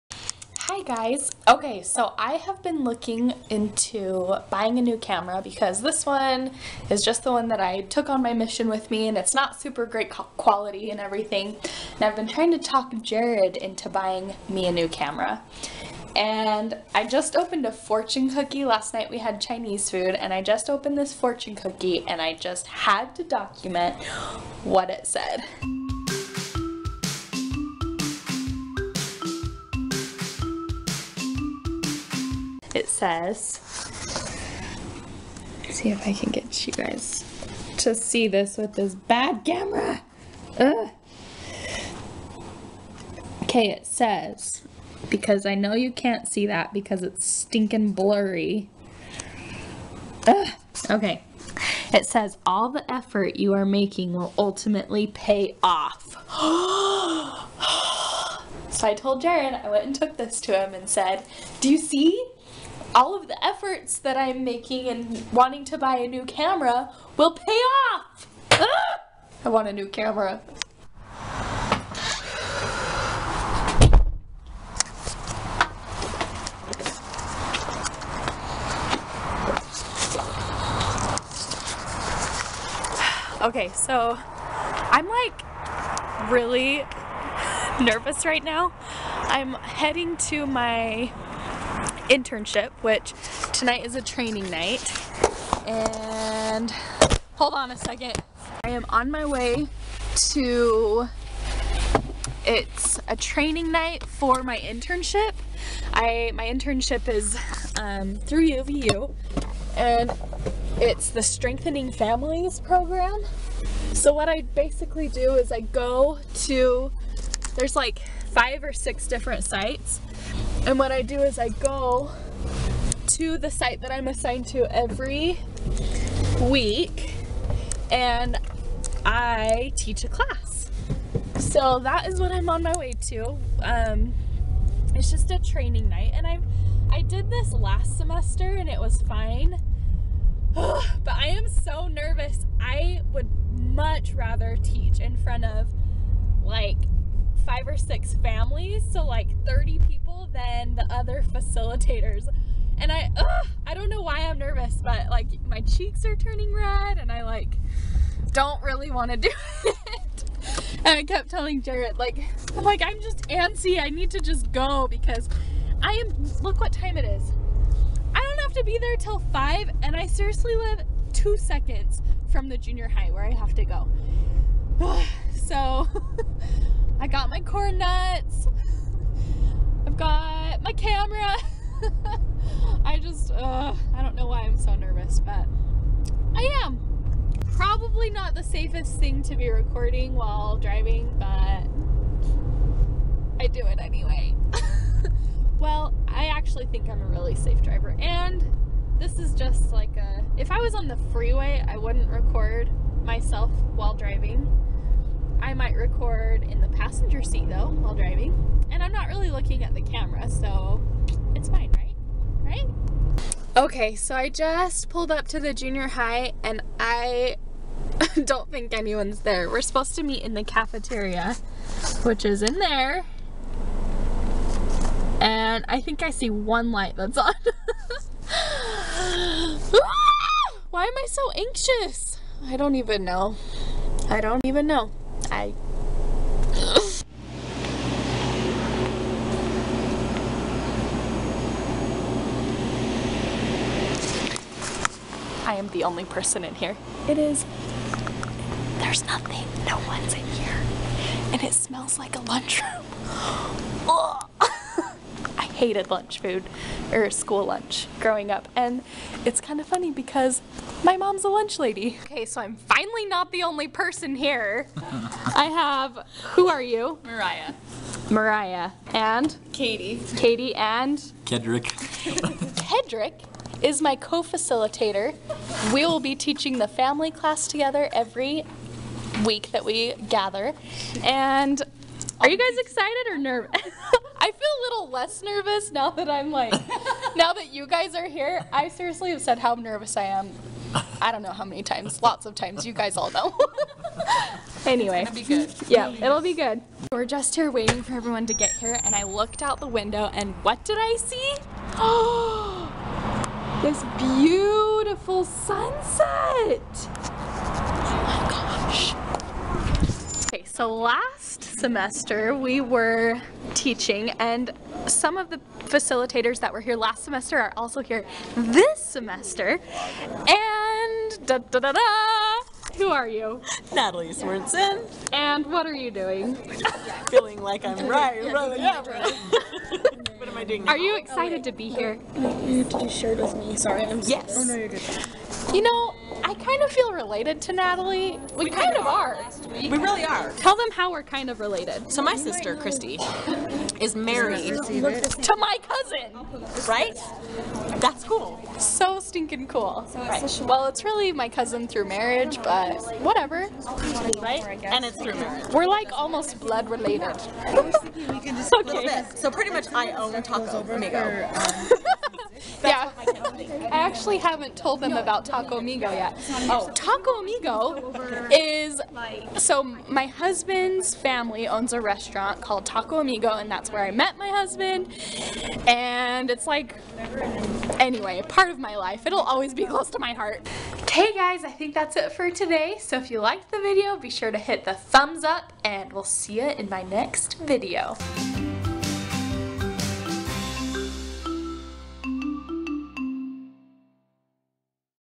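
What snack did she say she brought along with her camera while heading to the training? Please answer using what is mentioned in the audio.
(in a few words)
Corn nuts.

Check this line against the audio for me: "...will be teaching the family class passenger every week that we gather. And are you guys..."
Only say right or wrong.
wrong.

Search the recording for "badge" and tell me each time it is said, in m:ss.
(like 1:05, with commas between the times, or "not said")
not said.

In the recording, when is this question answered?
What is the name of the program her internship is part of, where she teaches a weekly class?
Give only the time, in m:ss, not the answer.
1:51.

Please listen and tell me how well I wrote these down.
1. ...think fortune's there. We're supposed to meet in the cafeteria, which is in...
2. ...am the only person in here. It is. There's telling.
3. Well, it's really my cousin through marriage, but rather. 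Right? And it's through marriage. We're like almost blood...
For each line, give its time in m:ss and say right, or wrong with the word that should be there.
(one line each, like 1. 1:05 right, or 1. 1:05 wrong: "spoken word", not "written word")
1. 3:38 wrong: "anyone", not "fortune"
2. 4:05 wrong: "nothing", not "telling"
3. 5:50 wrong: "whatever", not "rather".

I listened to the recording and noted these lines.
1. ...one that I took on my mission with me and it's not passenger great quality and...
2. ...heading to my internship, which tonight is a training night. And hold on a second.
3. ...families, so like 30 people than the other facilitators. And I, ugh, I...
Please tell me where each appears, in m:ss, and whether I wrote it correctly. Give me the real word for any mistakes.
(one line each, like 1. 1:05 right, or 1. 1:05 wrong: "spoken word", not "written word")
1. 0:07 wrong: "super", not "passenger"
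2. 1:29 right
3. 2:28 right.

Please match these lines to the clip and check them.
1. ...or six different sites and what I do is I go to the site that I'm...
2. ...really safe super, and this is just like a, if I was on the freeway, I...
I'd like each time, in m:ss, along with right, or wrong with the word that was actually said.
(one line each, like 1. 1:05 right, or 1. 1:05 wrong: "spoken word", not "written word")
1. 1:58 right
2. 3:17 wrong: "driver", not "super".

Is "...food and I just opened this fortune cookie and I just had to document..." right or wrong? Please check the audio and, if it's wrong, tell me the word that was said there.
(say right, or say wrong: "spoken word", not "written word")
right.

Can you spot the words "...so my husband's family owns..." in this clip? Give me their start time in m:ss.
6:09.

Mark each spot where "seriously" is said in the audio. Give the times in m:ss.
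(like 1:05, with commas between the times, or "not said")
2:50, 4:48.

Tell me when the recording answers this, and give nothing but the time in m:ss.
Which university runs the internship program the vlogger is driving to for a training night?
1:48.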